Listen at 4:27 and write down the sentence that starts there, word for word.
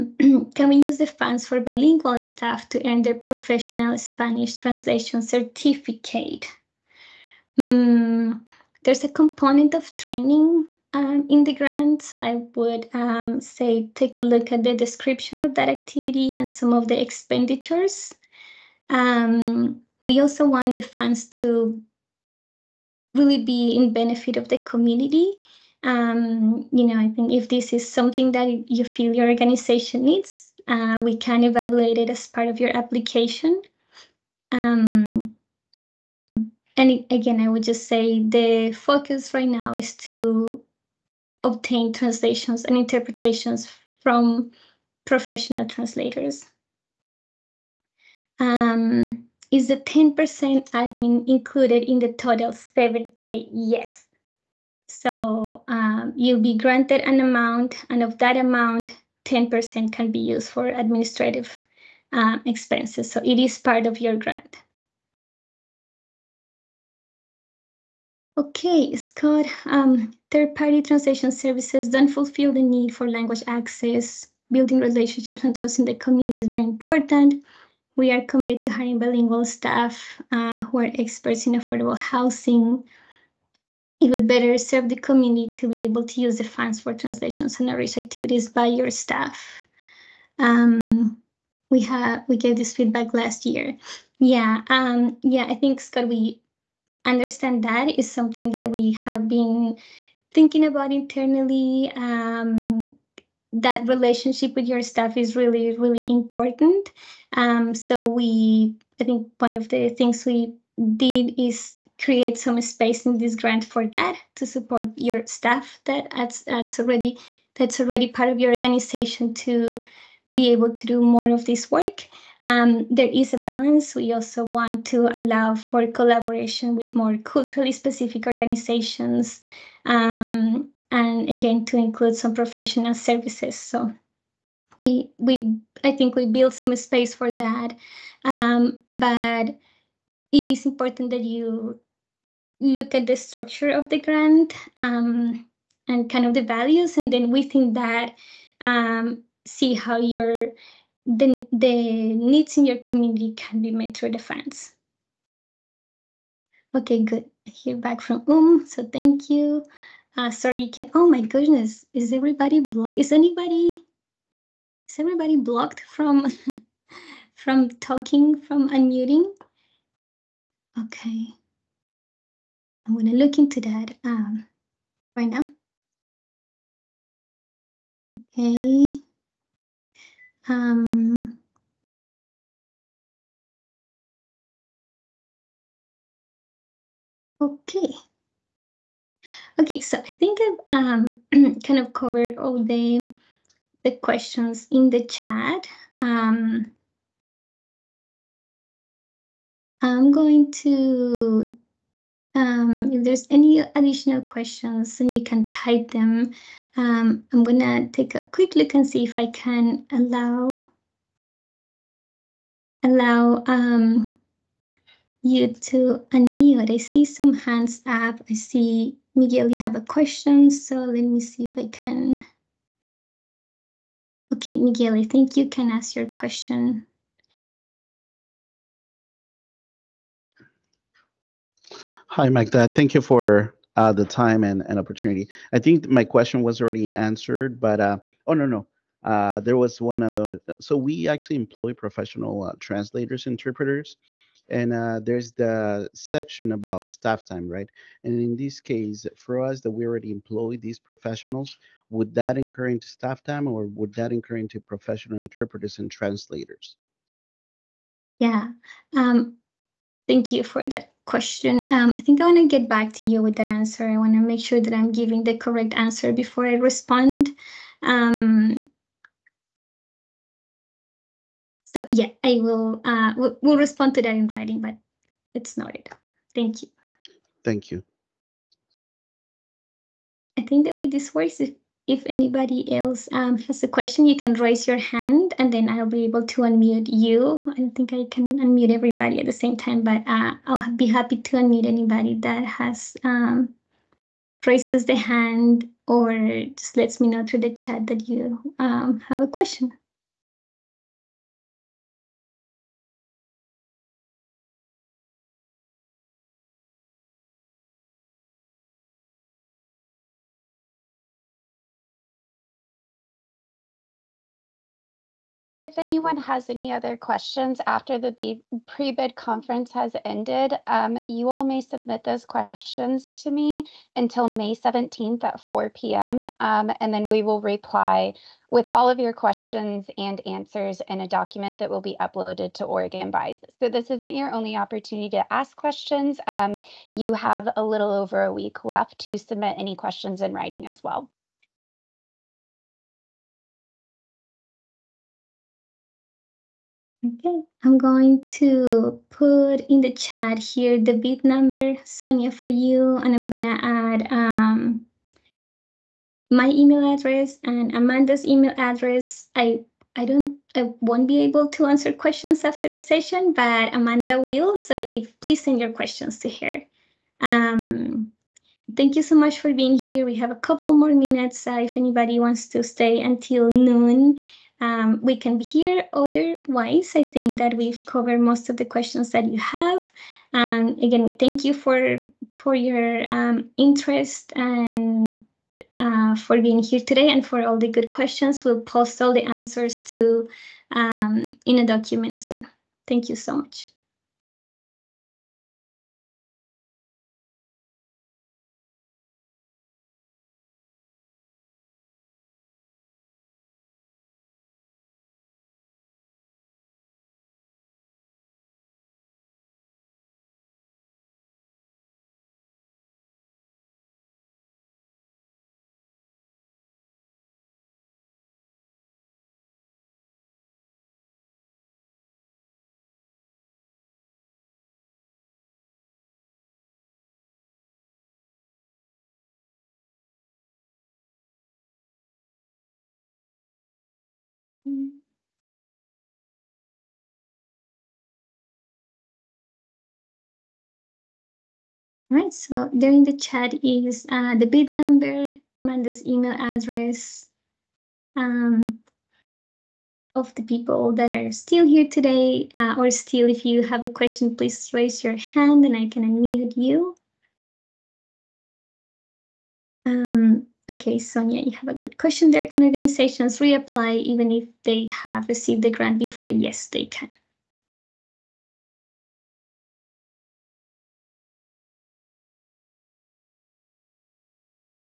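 Um, so yeah, I will uh, we'll, we'll respond to that in writing, but it's noted.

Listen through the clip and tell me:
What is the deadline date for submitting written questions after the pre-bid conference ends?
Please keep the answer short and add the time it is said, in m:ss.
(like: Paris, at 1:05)
May 17th, at 5:24.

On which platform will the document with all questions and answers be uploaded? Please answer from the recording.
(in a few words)
Oregon Buys.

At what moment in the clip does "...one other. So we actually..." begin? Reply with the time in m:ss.
3:59.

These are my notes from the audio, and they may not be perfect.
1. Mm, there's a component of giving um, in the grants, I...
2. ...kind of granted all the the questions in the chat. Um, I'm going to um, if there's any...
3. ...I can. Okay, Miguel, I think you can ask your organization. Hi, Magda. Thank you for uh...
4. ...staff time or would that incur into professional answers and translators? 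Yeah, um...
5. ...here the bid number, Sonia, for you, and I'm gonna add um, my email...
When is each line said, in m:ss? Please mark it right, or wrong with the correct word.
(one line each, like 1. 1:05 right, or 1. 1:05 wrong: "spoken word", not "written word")
1. 0:07 wrong: "training", not "giving"
2. 3:11 wrong: "covered", not "granted"
3. 3:41 wrong: "question", not "organization"
4. 4:12 wrong: "interpreters", not "answers"
5. 5:50 right.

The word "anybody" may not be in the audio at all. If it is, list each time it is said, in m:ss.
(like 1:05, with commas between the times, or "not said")
2:43, 4:42, 4:51, 6:11.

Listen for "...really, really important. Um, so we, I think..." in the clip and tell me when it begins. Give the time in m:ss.
1:45.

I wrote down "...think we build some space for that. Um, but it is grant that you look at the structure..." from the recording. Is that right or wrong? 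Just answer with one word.
wrong.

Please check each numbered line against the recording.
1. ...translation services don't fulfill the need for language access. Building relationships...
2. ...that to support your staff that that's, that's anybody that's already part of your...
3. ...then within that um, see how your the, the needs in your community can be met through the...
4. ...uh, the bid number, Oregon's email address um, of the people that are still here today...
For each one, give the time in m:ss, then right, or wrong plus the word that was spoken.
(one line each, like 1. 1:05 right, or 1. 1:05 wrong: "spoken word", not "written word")
1. 1:10 right
2. 1:53 wrong: "already", not "anybody"
3. 2:27 right
4. 7:24 wrong: "Amanda", not "Oregon".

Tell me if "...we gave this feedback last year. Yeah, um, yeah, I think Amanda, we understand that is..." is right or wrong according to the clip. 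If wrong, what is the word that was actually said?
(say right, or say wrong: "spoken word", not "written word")
wrong: "Scott", not "Amanda".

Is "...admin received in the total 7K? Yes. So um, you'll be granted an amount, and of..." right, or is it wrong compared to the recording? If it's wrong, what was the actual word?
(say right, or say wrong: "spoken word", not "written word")
wrong: "included", not "received".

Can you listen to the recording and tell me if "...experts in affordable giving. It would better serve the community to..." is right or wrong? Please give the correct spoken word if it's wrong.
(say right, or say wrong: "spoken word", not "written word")
wrong: "housing", not "giving".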